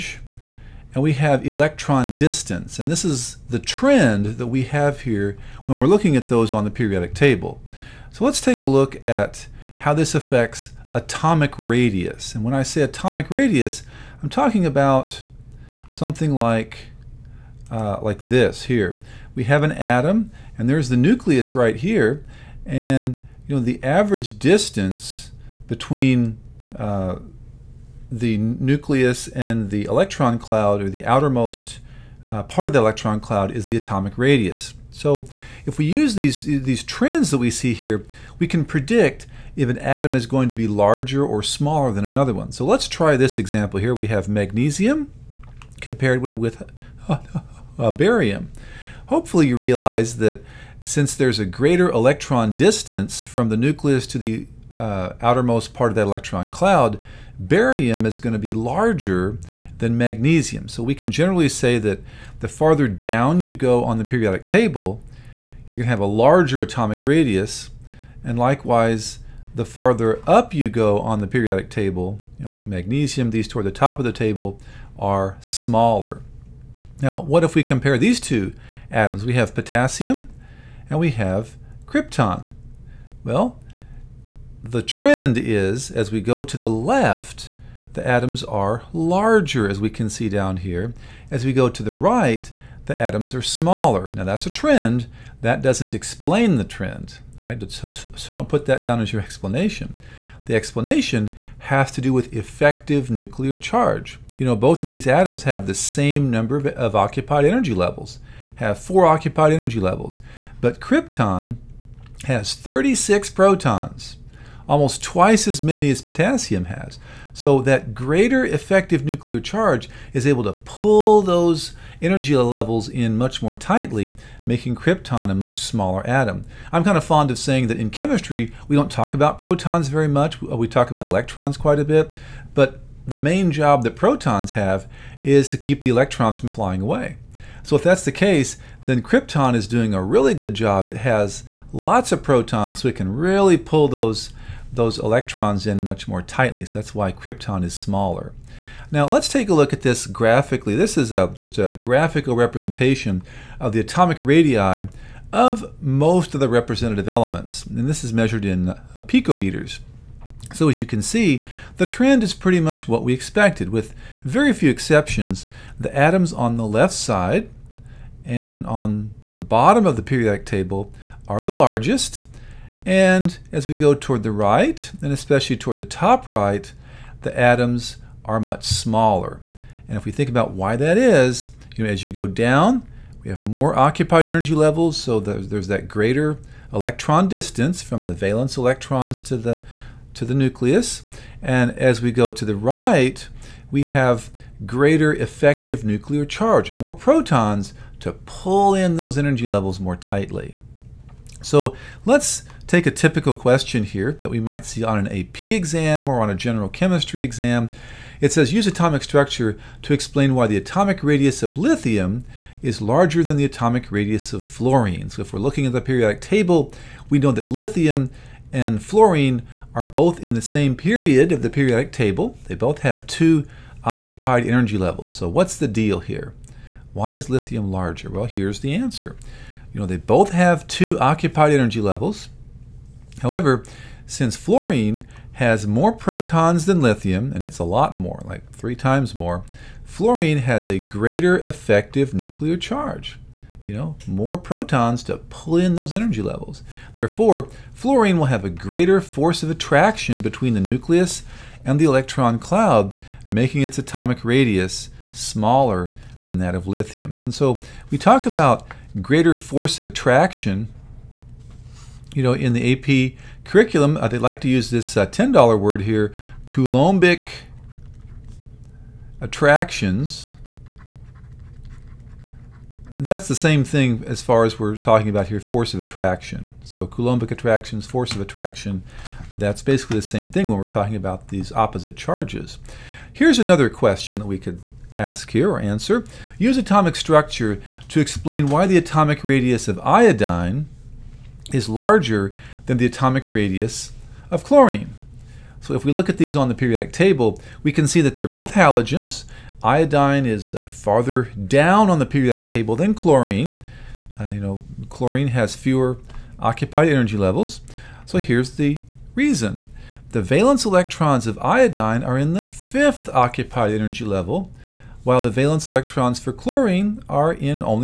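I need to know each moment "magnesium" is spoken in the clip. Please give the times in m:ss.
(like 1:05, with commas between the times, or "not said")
0:44, 0:59, 1:12.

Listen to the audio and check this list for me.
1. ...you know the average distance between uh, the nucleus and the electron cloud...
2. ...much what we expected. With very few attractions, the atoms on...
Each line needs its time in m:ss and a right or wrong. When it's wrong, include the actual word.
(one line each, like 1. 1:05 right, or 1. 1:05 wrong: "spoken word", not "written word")
1. 0:23 right
2. 2:42 wrong: "exceptions", not "attractions".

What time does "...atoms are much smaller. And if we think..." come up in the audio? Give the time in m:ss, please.
2:57.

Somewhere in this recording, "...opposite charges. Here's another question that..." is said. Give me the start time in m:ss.
4:41.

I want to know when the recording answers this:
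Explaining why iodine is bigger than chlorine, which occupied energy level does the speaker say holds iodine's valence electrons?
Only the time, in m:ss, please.
5:12.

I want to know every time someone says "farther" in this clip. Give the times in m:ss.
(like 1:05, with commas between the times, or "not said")
1:02, 1:09, 5:00.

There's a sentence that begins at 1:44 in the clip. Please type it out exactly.
You know, both of these atoms have the same number of, of occupied energy levels, have four occupied energy levels.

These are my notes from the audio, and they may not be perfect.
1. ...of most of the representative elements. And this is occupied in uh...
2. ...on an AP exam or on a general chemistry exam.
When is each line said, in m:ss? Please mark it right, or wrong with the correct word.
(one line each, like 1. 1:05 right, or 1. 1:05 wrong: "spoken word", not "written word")
1. 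2:35 wrong: "measured", not "occupied"
2. 3:24 right.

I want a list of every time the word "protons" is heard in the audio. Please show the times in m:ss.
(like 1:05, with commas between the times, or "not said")
1:53, 2:09, 2:13, 2:22, 3:16, 3:55, 4:04.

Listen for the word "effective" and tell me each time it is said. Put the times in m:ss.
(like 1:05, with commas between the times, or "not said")
1:42, 1:58, 3:15, 4:01.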